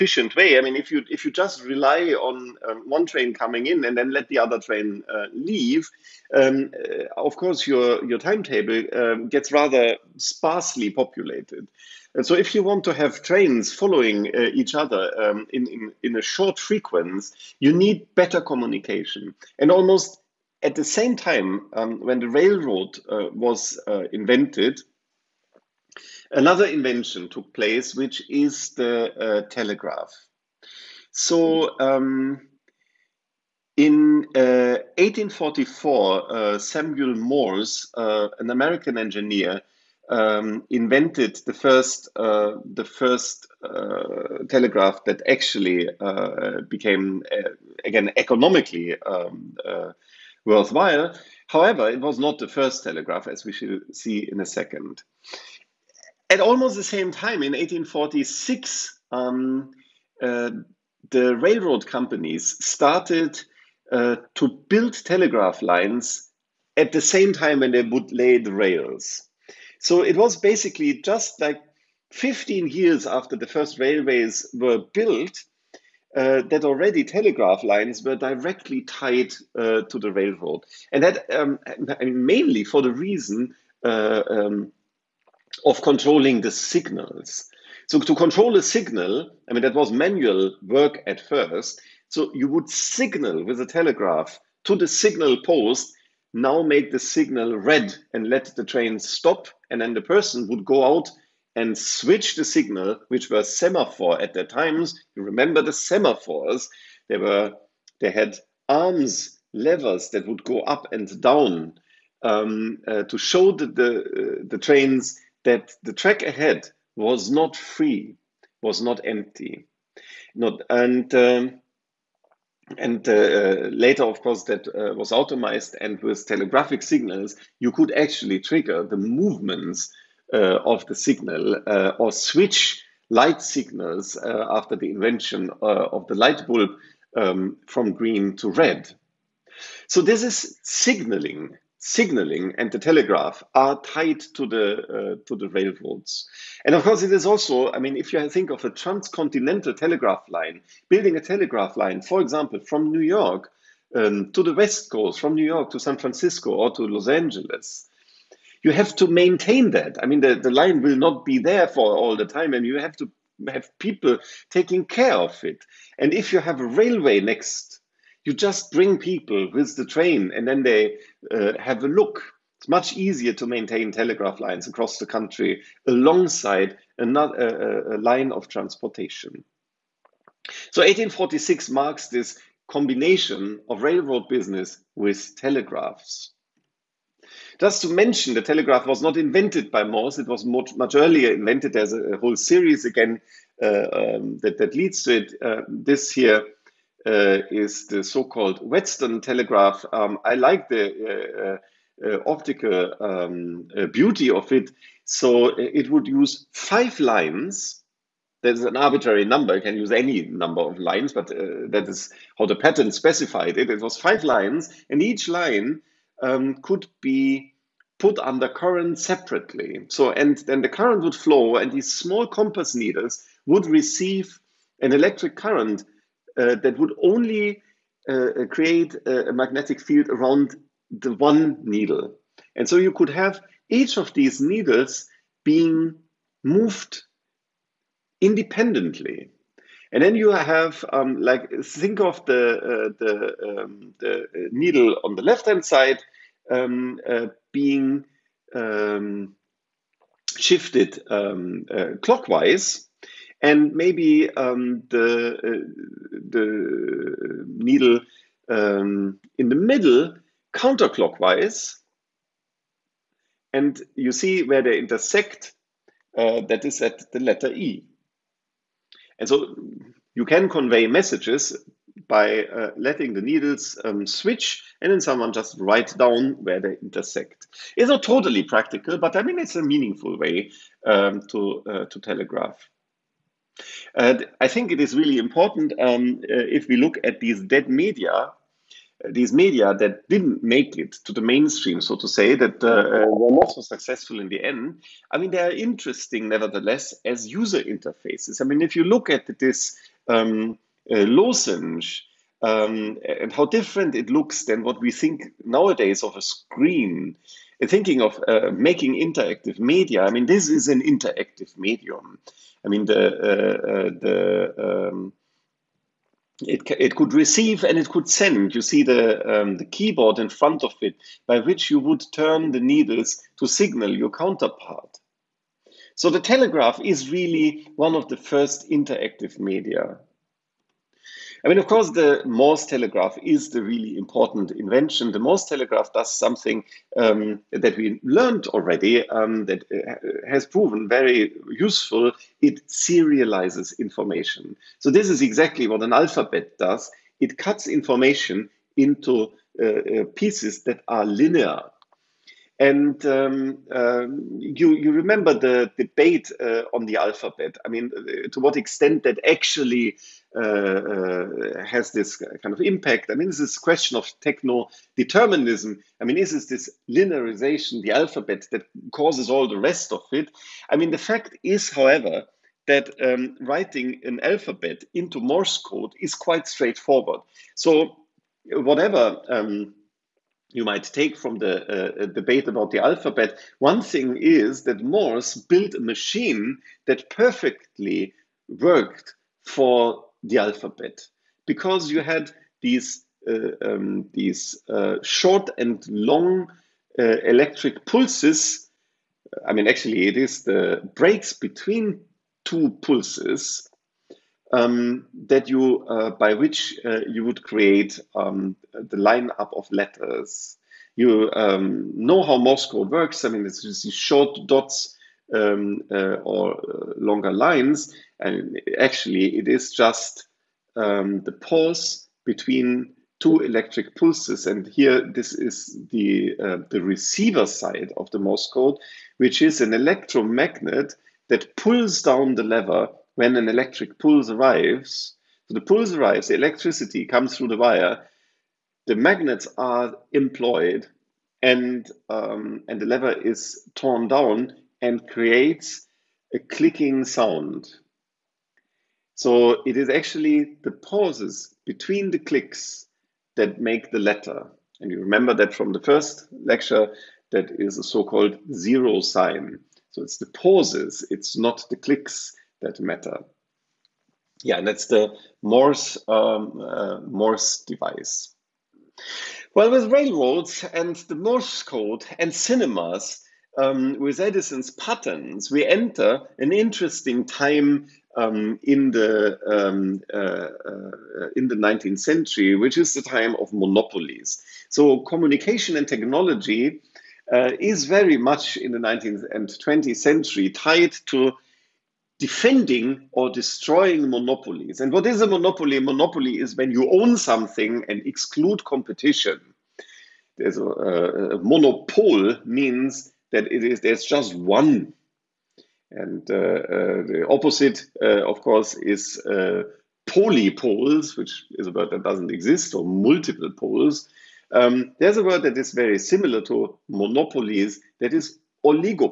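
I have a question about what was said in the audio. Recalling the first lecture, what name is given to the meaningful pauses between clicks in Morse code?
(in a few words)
zero sign.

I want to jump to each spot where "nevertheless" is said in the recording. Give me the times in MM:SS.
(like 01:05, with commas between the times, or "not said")
04:56.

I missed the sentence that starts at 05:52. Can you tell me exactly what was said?
And um, um, you, you remember the debate uh, on the alphabet.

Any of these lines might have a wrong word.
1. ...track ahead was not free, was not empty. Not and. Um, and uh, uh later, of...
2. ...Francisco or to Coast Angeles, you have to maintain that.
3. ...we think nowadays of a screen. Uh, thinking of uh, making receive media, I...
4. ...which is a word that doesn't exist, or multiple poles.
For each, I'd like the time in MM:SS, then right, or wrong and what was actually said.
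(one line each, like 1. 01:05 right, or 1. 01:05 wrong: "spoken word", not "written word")
1. 01:55 right
2. 02:35 wrong: "Los", not "Coast"
3. 05:04 wrong: "interactive", not "receive"
4. 08:31 right.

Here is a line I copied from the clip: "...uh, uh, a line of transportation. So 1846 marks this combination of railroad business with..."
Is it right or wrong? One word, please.
right.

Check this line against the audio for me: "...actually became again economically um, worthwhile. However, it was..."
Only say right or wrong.
right.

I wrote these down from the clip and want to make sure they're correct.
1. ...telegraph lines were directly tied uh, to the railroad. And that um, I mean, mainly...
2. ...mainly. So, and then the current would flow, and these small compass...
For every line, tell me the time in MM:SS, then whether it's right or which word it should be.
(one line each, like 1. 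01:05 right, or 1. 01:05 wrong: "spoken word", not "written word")
1. 01:17 right
2. 03:38 wrong: "separately", not "mainly".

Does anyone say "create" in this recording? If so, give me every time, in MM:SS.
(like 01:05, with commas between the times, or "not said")
03:48, 06:47, 07:25.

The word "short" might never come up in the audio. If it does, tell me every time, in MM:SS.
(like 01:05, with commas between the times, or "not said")
00:16, 06:35, 06:53.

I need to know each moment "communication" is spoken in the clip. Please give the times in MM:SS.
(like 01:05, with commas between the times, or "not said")
00:18, 08:05.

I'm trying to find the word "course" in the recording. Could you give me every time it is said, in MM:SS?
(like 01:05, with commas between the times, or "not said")
00:07, 02:04, 02:26, 05:31, 08:28.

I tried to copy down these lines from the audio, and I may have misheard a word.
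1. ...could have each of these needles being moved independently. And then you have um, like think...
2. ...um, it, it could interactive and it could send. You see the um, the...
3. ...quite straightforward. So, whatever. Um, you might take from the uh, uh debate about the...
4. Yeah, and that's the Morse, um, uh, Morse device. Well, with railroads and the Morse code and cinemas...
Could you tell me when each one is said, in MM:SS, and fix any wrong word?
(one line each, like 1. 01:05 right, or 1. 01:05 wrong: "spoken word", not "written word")
1. 03:52 right
2. 05:14 wrong: "receive", not "interactive"
3. 06:16 right
4. 07:44 right.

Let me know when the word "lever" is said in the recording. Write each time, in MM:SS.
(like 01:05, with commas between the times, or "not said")
01:49, 07:12, 07:22.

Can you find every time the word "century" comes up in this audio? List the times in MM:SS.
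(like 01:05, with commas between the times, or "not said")
08:02, 08:09.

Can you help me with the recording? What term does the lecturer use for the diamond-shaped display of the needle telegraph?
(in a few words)
lozenge.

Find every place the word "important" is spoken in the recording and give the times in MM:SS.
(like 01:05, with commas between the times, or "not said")
04:45, 05:33.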